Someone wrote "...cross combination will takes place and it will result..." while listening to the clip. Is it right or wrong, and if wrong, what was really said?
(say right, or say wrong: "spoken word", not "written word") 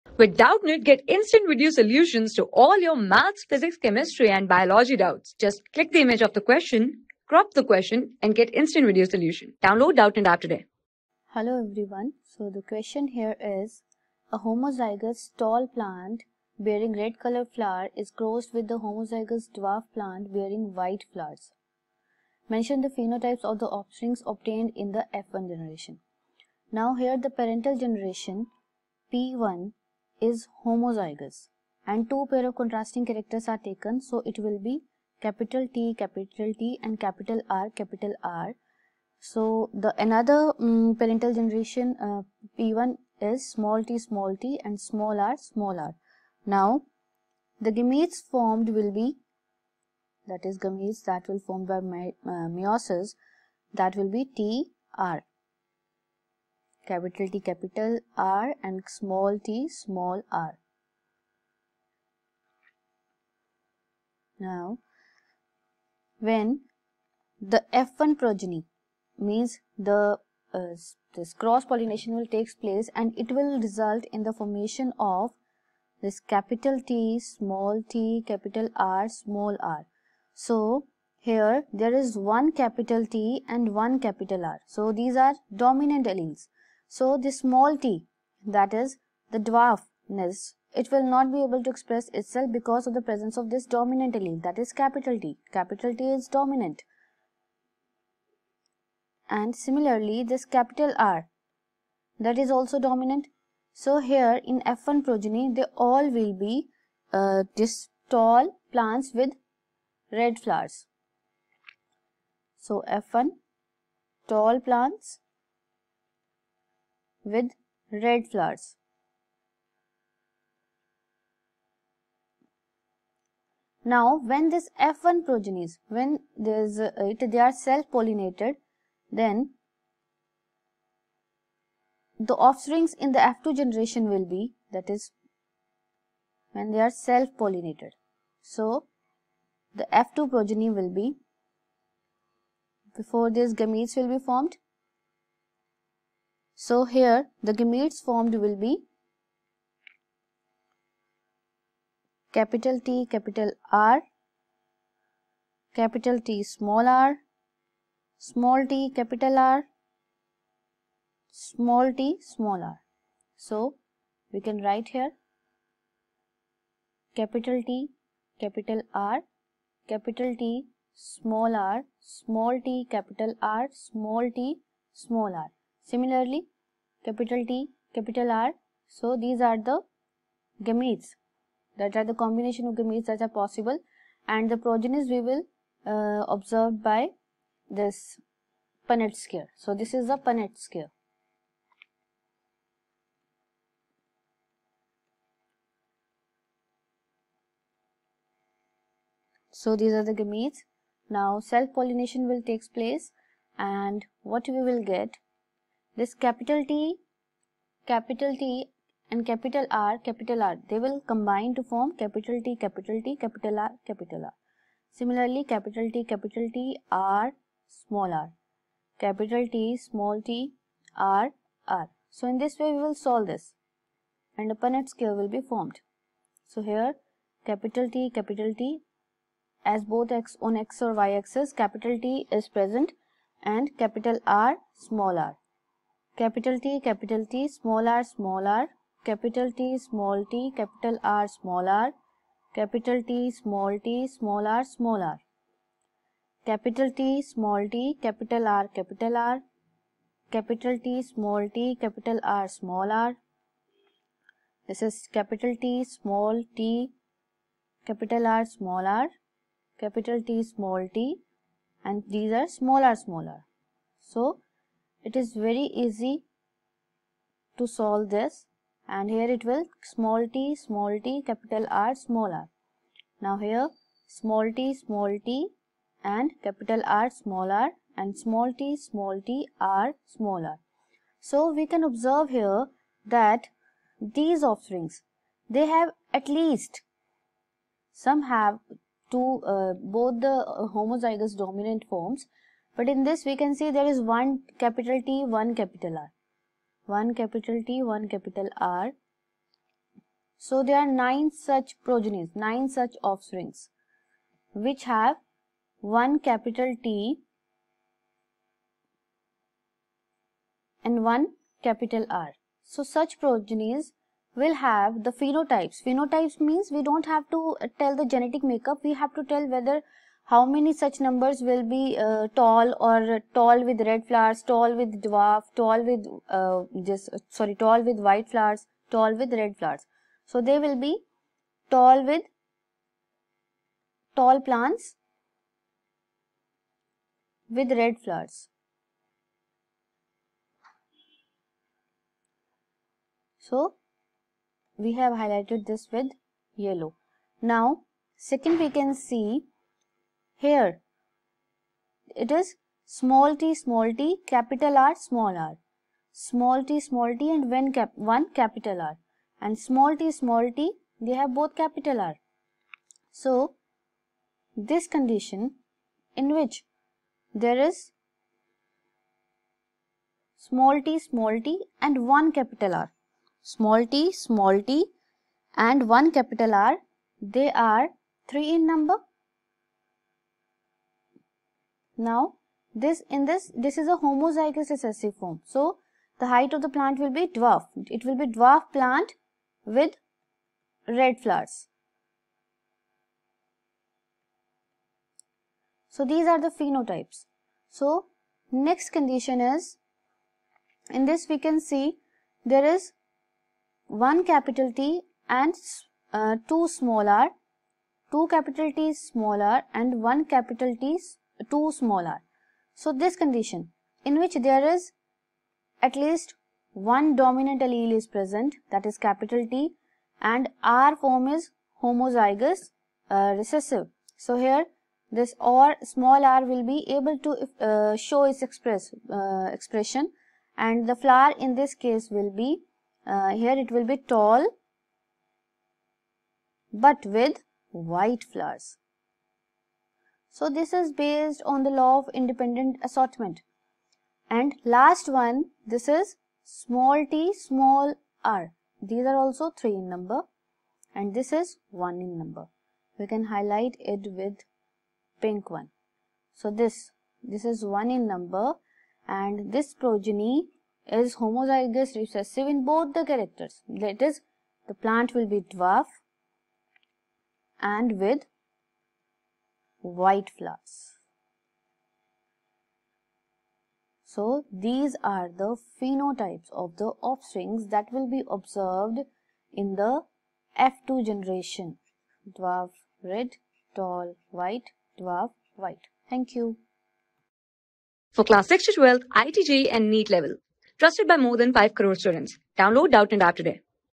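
wrong: "pollination", not "combination".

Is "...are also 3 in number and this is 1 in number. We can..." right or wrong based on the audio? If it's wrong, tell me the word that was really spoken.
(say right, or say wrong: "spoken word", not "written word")
right.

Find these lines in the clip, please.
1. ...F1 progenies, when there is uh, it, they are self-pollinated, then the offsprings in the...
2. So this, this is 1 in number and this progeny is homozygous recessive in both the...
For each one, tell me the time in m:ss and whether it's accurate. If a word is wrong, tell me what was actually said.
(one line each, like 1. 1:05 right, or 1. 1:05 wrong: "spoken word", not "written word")
1. 2:04 right
2. 7:36 right.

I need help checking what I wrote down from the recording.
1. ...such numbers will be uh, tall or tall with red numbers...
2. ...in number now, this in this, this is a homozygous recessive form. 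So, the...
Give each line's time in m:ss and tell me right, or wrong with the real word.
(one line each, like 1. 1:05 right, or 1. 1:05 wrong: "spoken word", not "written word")
1. 5:20 wrong: "flowers", not "numbers"
2. 6:18 right.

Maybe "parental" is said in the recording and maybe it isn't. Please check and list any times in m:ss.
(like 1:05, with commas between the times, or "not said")
0:27, 0:40.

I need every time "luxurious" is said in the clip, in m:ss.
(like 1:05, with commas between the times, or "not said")
not said.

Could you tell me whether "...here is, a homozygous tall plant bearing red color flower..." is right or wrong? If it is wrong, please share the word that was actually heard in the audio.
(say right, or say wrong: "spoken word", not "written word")
right.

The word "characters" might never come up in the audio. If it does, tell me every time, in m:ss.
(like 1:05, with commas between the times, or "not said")
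0:33, 7:43.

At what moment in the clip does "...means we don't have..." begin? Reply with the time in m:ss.
5:16.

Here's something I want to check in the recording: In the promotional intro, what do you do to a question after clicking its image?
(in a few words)
Crop the question.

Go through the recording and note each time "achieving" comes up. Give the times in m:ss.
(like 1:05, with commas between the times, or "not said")
not said.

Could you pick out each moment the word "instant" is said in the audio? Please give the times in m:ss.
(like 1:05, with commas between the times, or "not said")
0:01, 0:08.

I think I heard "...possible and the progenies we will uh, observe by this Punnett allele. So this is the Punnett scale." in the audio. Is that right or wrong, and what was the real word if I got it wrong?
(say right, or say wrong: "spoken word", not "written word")
wrong: "scale", not "allele".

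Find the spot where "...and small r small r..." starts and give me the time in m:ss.
0:44.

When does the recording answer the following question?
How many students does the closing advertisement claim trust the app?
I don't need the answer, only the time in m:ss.
8:11.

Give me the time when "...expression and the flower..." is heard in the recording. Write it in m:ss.
7:09.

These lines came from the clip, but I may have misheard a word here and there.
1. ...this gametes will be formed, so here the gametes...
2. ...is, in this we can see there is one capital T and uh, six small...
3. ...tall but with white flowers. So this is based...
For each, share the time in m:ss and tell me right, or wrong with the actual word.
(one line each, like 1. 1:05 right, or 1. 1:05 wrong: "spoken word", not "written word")
1. 2:23 right
2. 6:39 wrong: "two", not "six"
3. 7:13 right.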